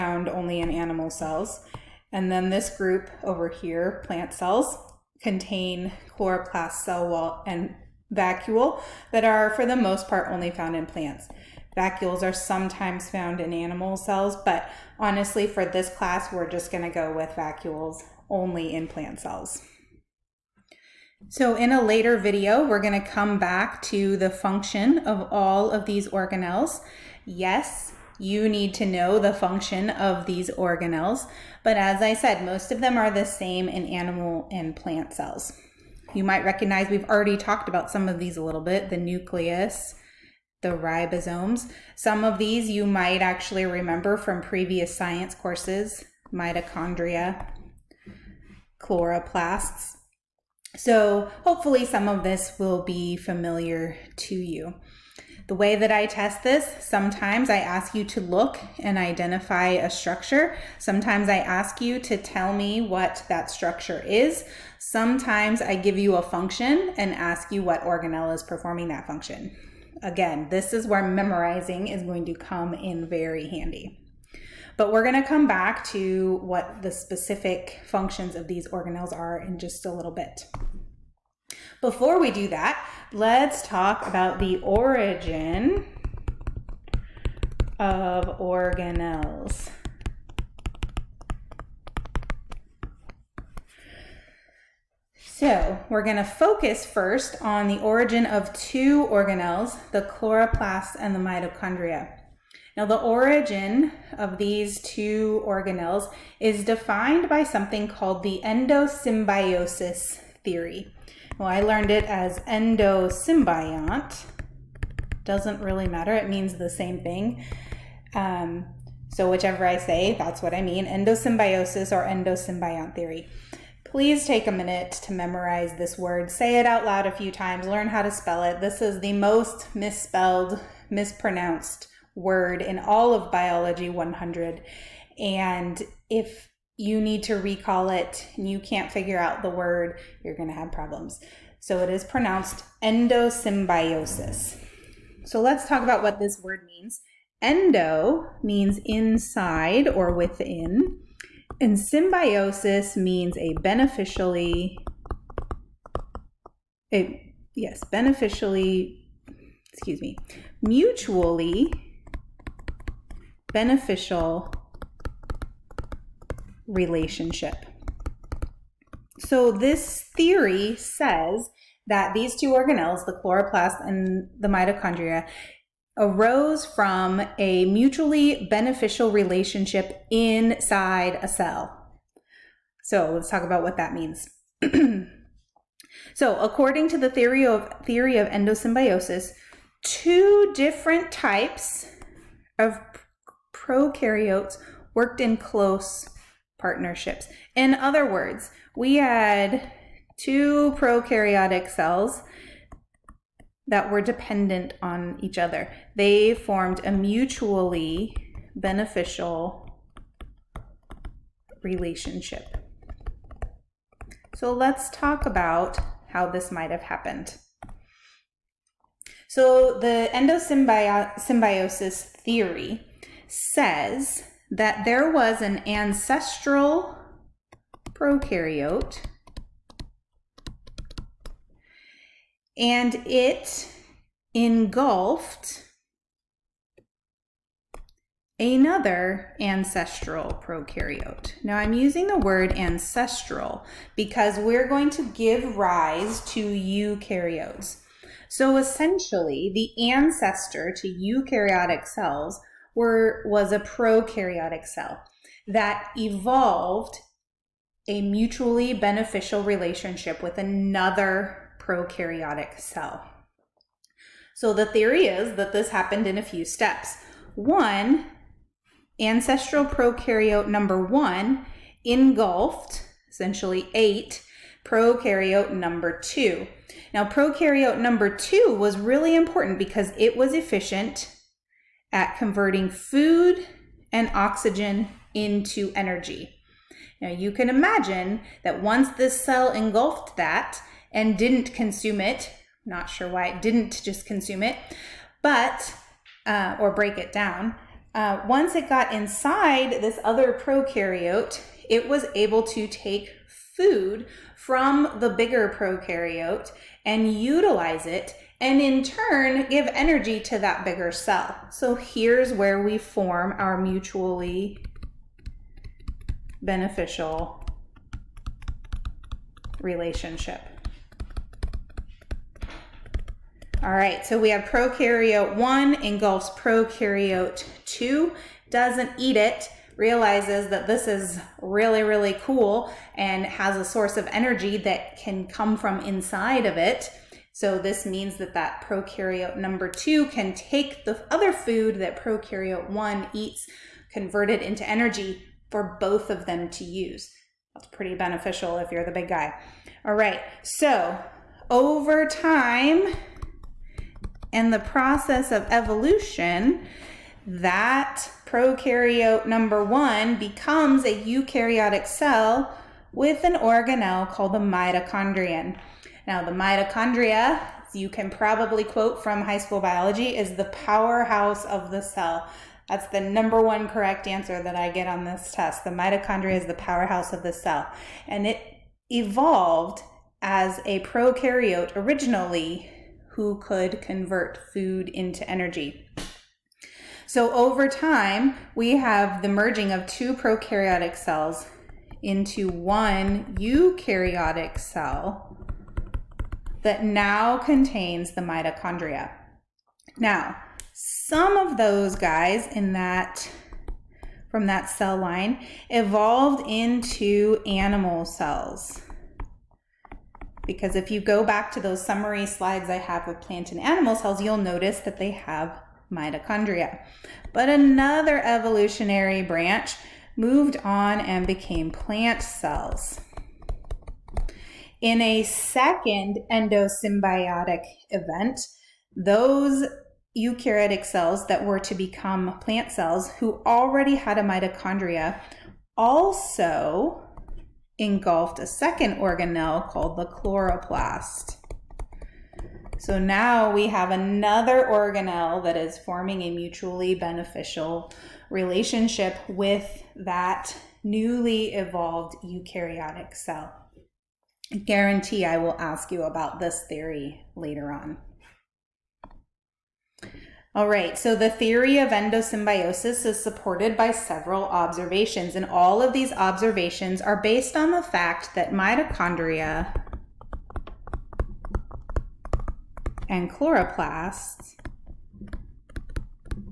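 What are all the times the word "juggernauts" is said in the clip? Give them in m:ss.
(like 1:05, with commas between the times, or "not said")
not said.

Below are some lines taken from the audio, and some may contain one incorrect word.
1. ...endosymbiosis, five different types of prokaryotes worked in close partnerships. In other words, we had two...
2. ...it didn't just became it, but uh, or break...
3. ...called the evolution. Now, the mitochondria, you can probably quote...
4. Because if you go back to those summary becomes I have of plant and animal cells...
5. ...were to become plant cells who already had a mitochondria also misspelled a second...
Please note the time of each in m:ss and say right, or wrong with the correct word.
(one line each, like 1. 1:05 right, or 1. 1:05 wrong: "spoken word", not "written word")
1. 3:08 wrong: "two", not "five"
2. 4:53 wrong: "consume", not "became"
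3. 6:04 wrong: "mitochondrion", not "evolution"
4. 6:50 wrong: "slides", not "becomes"
5. 7:11 wrong: "engulfed", not "misspelled".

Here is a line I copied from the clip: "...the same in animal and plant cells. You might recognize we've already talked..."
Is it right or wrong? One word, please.
right.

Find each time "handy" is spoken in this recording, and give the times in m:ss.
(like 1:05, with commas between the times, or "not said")
1:13.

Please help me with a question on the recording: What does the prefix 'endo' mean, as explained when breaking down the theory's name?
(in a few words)
inside or within.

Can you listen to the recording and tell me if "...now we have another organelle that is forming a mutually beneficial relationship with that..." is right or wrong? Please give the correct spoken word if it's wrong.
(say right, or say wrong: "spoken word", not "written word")
right.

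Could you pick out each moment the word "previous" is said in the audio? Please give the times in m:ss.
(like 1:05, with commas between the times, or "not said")
0:44.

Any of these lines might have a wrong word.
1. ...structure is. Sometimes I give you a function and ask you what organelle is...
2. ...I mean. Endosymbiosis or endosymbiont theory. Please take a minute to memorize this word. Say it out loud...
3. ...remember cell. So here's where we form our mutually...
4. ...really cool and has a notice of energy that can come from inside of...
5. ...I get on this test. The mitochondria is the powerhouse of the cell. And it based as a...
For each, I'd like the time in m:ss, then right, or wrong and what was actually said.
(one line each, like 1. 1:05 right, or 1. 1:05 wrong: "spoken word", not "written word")
1. 1:03 right
2. 2:00 right
3. 5:10 wrong: "bigger", not "remember"
4. 5:31 wrong: "source", not "notice"
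5. 6:14 wrong: "evolved", not "based".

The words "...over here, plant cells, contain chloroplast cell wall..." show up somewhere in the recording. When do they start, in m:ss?
0:03.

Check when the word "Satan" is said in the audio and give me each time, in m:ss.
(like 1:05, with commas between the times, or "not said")
not said.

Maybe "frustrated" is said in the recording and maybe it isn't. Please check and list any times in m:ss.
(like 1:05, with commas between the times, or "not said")
not said.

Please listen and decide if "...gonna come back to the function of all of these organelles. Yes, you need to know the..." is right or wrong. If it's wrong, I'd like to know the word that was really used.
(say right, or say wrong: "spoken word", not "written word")
right.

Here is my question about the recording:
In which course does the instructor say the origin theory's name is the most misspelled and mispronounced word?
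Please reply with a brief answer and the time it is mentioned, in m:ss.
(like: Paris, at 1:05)
Biology 100, at 2:13.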